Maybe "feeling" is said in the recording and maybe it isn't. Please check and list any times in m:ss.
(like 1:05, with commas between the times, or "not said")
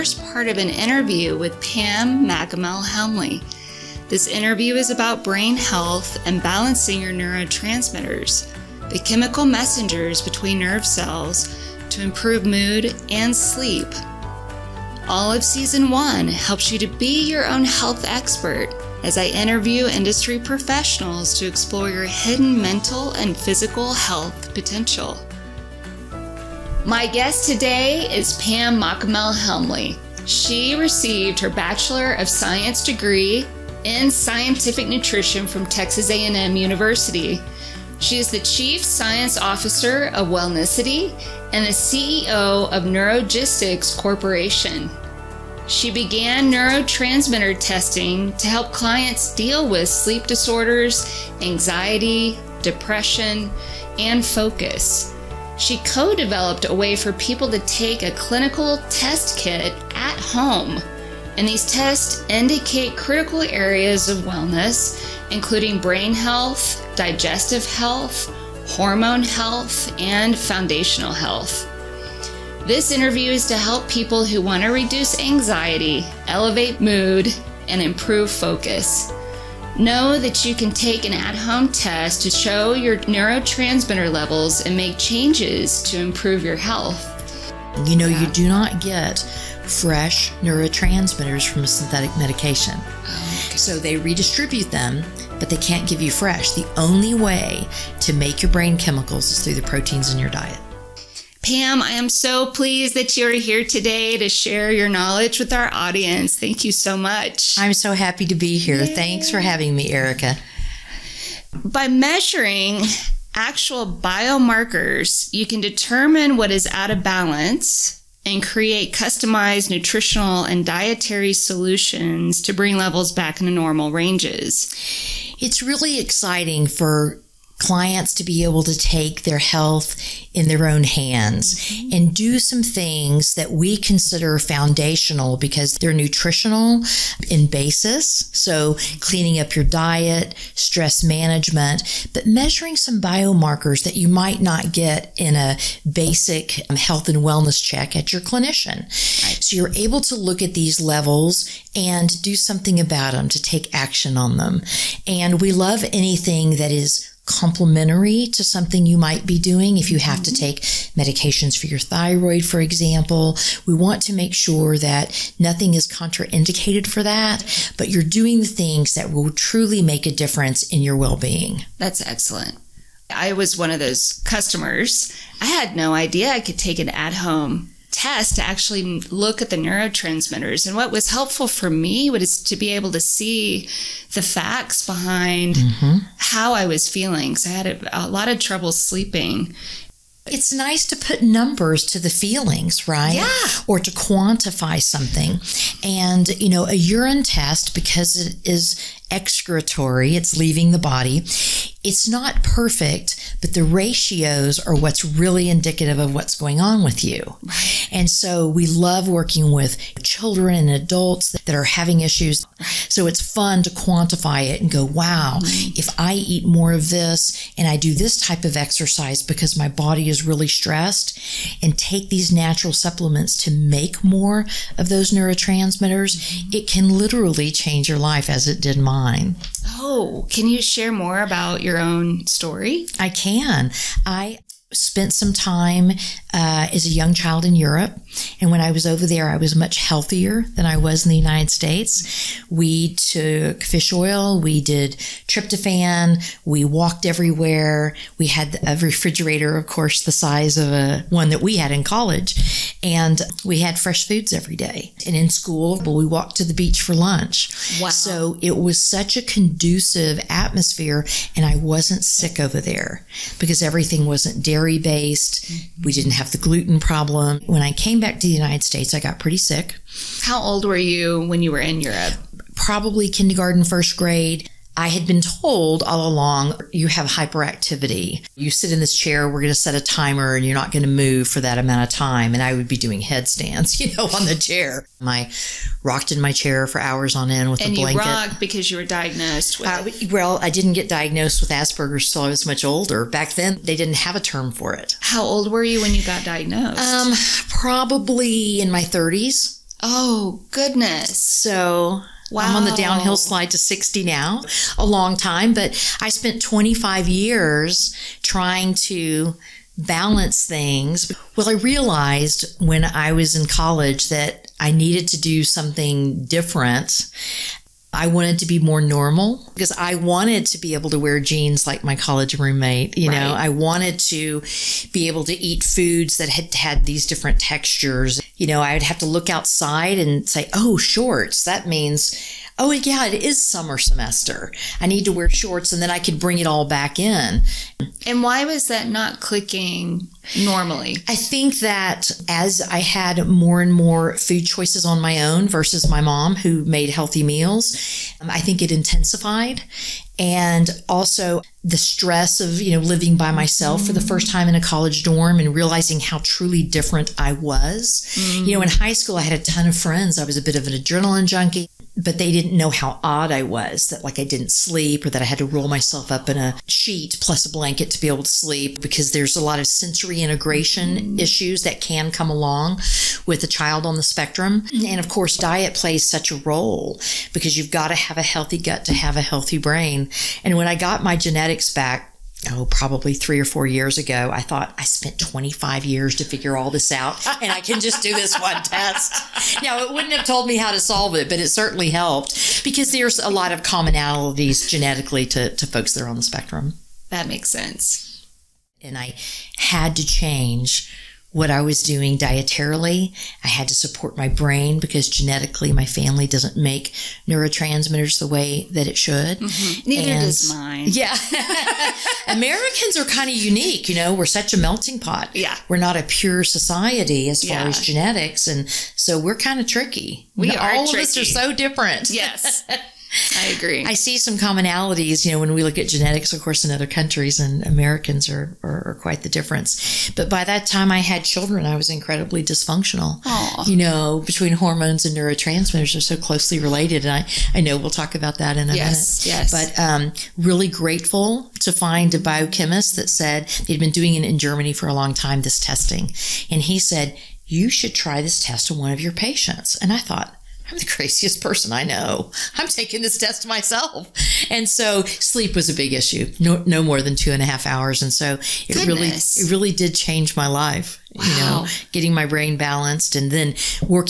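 3:06, 3:12.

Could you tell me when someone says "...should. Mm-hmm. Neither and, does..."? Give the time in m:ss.
6:48.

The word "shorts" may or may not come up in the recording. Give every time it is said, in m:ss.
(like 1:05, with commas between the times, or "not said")
5:30, 5:35.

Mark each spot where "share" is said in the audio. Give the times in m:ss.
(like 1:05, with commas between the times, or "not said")
1:44, 3:50.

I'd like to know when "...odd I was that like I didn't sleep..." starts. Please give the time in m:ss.
6:03.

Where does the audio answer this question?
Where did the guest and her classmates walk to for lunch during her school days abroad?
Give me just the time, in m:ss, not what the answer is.
4:16.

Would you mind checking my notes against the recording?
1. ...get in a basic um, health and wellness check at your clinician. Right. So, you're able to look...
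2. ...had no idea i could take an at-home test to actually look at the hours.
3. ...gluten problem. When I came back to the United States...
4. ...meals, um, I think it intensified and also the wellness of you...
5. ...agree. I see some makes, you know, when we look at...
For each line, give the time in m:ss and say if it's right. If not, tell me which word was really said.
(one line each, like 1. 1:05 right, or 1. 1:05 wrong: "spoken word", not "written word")
1. 2:24 right
2. 2:55 wrong: "neurotransmitters", not "hours"
3. 4:26 right
4. 5:47 wrong: "stress", not "wellness"
5. 7:03 wrong: "commonalities", not "makes".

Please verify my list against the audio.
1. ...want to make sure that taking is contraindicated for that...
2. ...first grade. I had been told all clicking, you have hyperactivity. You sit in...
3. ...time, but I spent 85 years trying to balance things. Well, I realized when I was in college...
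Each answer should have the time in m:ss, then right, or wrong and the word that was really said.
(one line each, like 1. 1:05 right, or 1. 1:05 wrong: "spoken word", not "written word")
1. 2:43 wrong: "nothing", not "taking"
2. 4:33 wrong: "along", not "clicking"
3. 5:05 wrong: "25", not "85".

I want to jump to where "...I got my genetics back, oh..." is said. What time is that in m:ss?
6:20.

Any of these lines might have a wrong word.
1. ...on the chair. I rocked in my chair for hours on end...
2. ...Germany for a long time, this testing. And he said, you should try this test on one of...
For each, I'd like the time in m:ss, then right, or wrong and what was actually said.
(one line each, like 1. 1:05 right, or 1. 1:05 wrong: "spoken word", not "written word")
1. 4:44 right
2. 7:24 right.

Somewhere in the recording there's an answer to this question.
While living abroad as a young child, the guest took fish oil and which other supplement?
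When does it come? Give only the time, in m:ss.
4:05.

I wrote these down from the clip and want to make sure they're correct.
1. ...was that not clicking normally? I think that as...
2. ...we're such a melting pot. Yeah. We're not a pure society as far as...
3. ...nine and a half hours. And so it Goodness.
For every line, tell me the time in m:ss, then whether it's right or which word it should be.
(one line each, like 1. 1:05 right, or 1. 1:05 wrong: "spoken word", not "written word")
1. 5:38 right
2. 6:54 right
3. 7:37 wrong: "two", not "nine".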